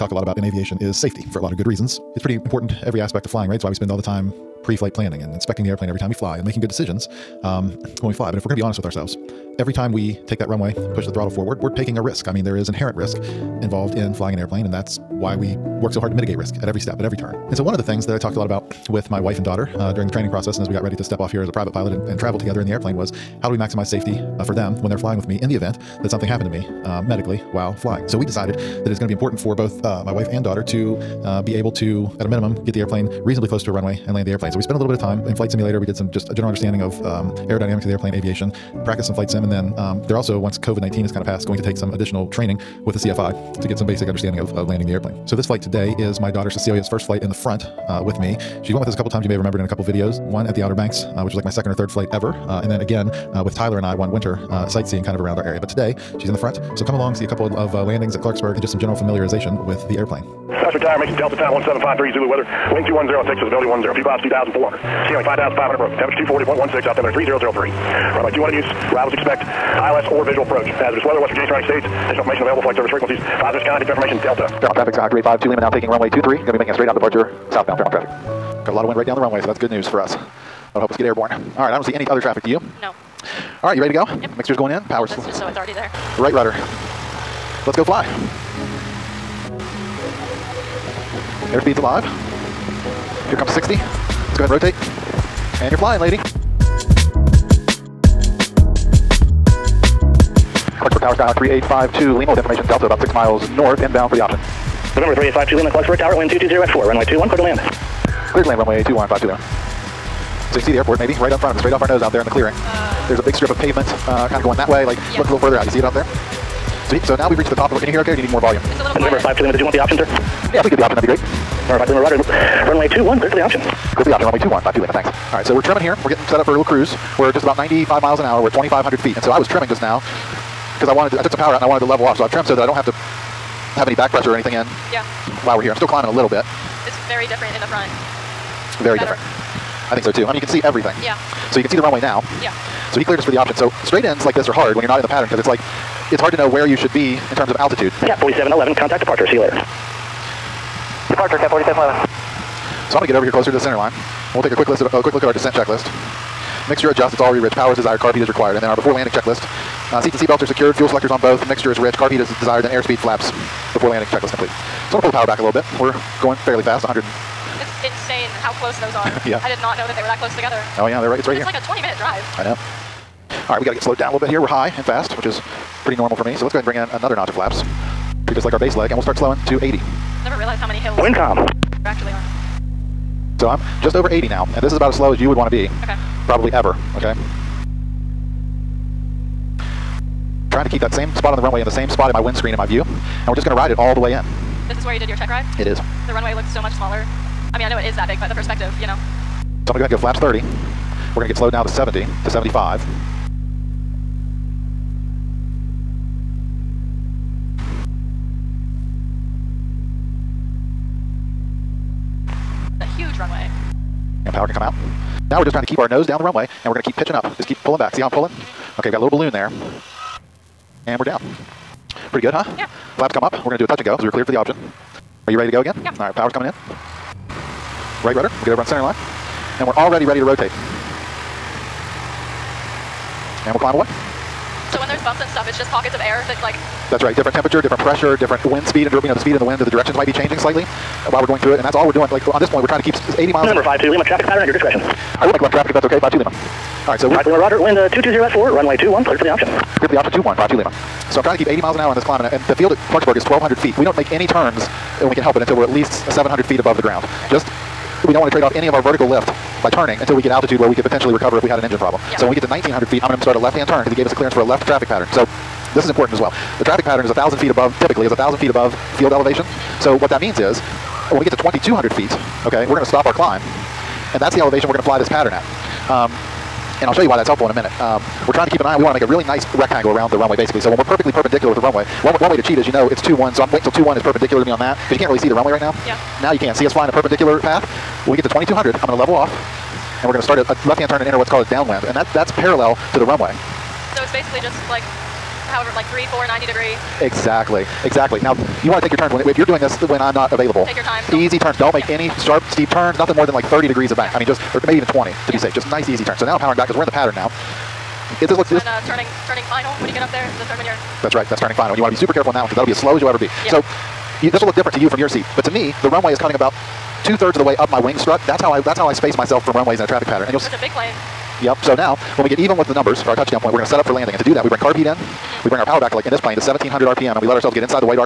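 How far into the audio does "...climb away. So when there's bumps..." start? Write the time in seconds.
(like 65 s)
233 s.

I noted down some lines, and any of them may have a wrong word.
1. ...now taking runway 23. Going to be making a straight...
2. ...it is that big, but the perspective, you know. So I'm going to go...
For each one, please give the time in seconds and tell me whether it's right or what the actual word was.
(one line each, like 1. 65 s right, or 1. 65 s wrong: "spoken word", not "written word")
1. 75 s right
2. 197 s right.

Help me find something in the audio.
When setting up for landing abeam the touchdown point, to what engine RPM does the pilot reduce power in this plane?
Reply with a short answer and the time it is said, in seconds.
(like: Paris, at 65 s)
1700 rpm, at 326 s.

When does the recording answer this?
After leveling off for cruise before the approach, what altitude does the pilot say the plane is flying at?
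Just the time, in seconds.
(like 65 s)
128 s.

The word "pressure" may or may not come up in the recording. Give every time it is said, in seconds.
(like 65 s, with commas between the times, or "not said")
134 s, 237 s.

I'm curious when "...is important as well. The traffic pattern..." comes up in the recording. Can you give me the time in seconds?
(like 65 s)
265 s.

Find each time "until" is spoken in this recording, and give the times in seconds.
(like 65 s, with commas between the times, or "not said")
255 s, 259 s, 283 s.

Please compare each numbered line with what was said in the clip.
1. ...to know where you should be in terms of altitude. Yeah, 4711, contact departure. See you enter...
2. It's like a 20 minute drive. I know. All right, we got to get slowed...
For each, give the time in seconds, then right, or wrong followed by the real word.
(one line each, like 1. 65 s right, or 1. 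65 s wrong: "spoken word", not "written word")
1. 146 s wrong: "later", not "enter"
2. 171 s right.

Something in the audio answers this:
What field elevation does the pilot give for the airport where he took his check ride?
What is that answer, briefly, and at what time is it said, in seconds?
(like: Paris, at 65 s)
1,200 feet, at 253 s.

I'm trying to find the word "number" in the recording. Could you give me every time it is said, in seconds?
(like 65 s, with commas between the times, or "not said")
243 s, 322 s.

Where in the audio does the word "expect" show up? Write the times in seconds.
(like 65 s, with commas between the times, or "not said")
69 s.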